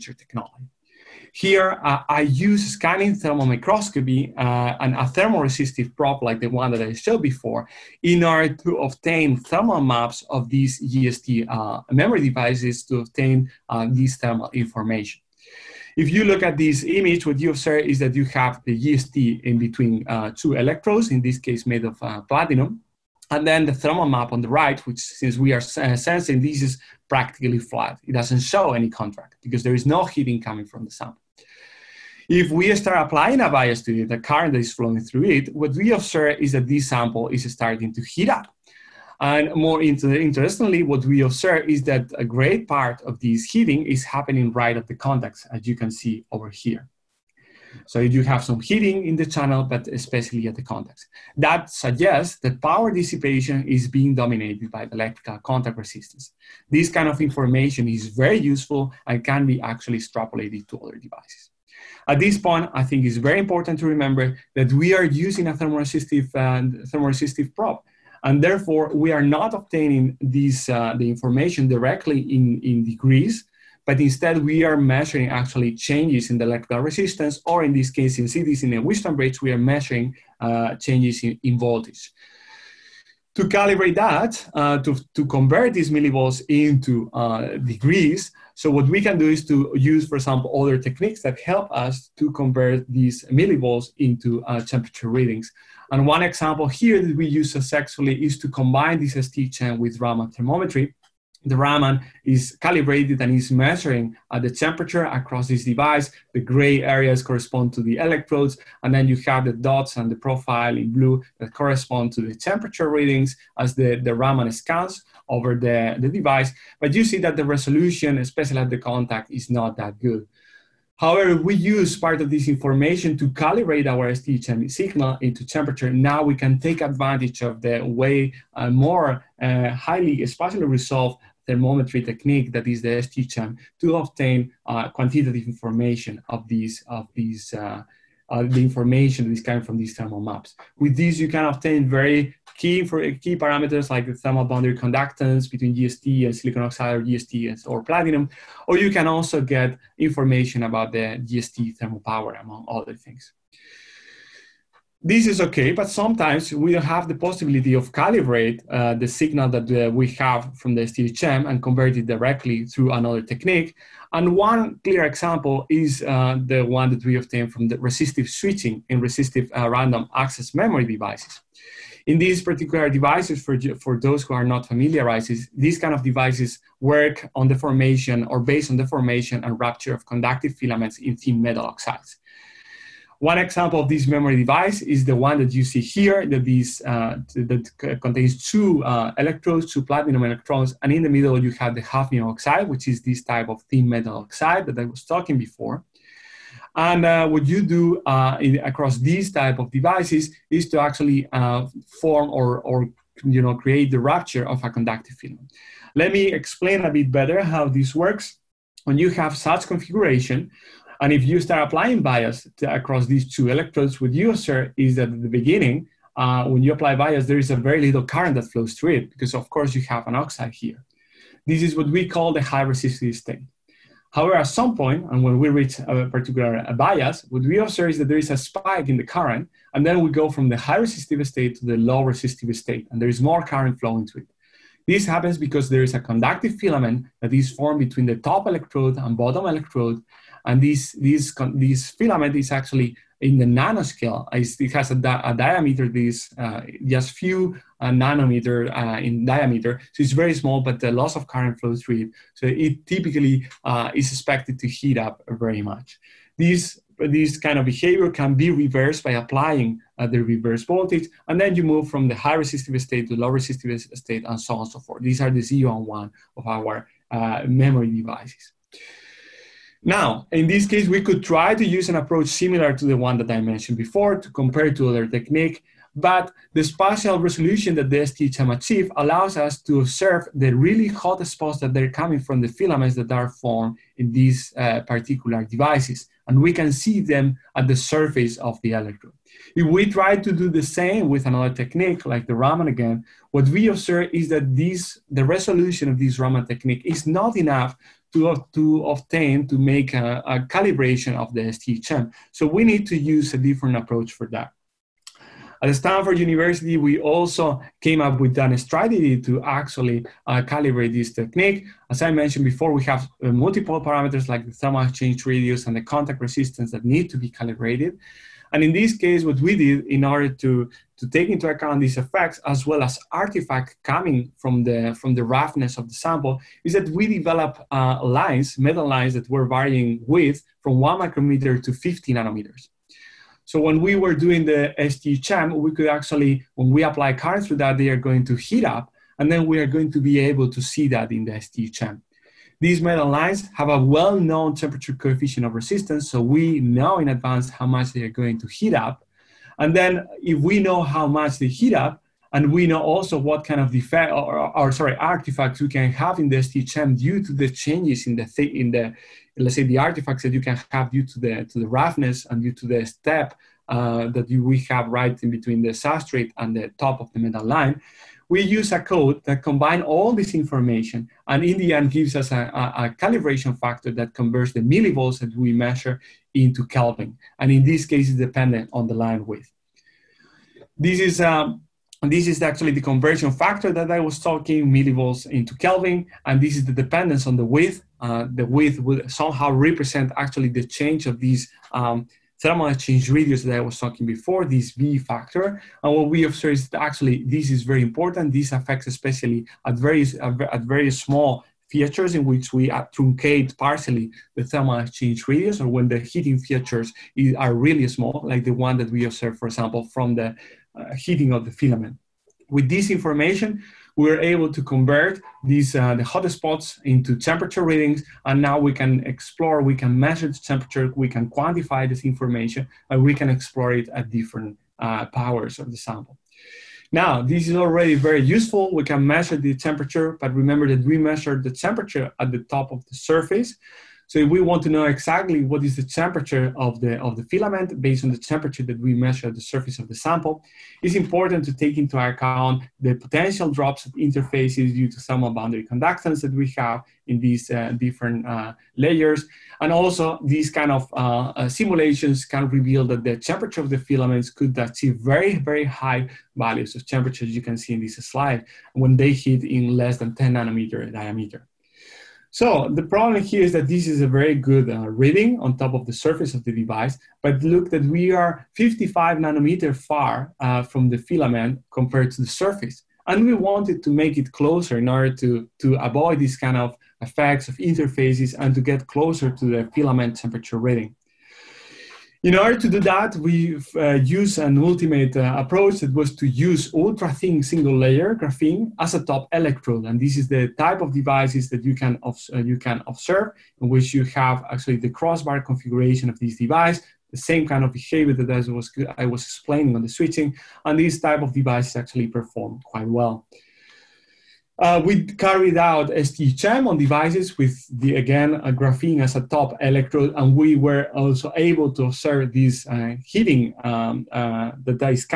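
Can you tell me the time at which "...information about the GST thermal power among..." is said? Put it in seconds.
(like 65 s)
149 s.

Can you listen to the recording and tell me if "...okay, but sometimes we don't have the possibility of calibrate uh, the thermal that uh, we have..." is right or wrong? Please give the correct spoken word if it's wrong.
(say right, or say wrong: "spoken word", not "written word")
wrong: "signal", not "thermal".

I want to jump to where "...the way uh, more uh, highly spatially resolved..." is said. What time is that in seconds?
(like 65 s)
127 s.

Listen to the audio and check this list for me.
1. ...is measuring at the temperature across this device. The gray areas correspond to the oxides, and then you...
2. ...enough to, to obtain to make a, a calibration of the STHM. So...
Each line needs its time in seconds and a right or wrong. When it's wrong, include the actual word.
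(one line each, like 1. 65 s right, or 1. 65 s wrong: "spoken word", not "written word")
1. 103 s wrong: "electrodes", not "oxides"
2. 297 s right.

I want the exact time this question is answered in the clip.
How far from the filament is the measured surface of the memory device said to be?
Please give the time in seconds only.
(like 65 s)
468 s.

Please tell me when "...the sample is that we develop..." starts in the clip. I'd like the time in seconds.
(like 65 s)
325 s.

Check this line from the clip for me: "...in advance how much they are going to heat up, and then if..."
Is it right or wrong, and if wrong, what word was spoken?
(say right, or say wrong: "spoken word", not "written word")
right.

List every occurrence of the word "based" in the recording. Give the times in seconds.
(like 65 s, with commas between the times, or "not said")
178 s, 437 s.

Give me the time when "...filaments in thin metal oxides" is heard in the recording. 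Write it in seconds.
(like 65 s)
180 s.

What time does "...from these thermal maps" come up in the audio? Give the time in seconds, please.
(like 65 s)
139 s.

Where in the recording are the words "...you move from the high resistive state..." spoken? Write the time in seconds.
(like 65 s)
261 s.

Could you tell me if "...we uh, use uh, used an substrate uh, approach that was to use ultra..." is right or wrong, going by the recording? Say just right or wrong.
wrong.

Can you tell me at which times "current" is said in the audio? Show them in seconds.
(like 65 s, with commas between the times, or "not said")
34 s, 218 s, 229 s, 233 s, 251 s, 337 s.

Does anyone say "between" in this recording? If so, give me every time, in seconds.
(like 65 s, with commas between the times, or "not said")
19 s, 145 s, 237 s, 365 s.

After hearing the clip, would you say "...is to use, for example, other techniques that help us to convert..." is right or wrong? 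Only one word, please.
right.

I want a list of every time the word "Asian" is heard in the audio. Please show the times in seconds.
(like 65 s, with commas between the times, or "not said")
not said.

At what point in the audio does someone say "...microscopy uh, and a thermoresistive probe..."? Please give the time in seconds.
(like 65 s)
3 s.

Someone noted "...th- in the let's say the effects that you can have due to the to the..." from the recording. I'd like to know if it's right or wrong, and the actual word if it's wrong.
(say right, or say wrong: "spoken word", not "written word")
wrong: "artifacts", not "effects".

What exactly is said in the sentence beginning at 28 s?
It doesn't show any contract because there is no heating coming from the sample.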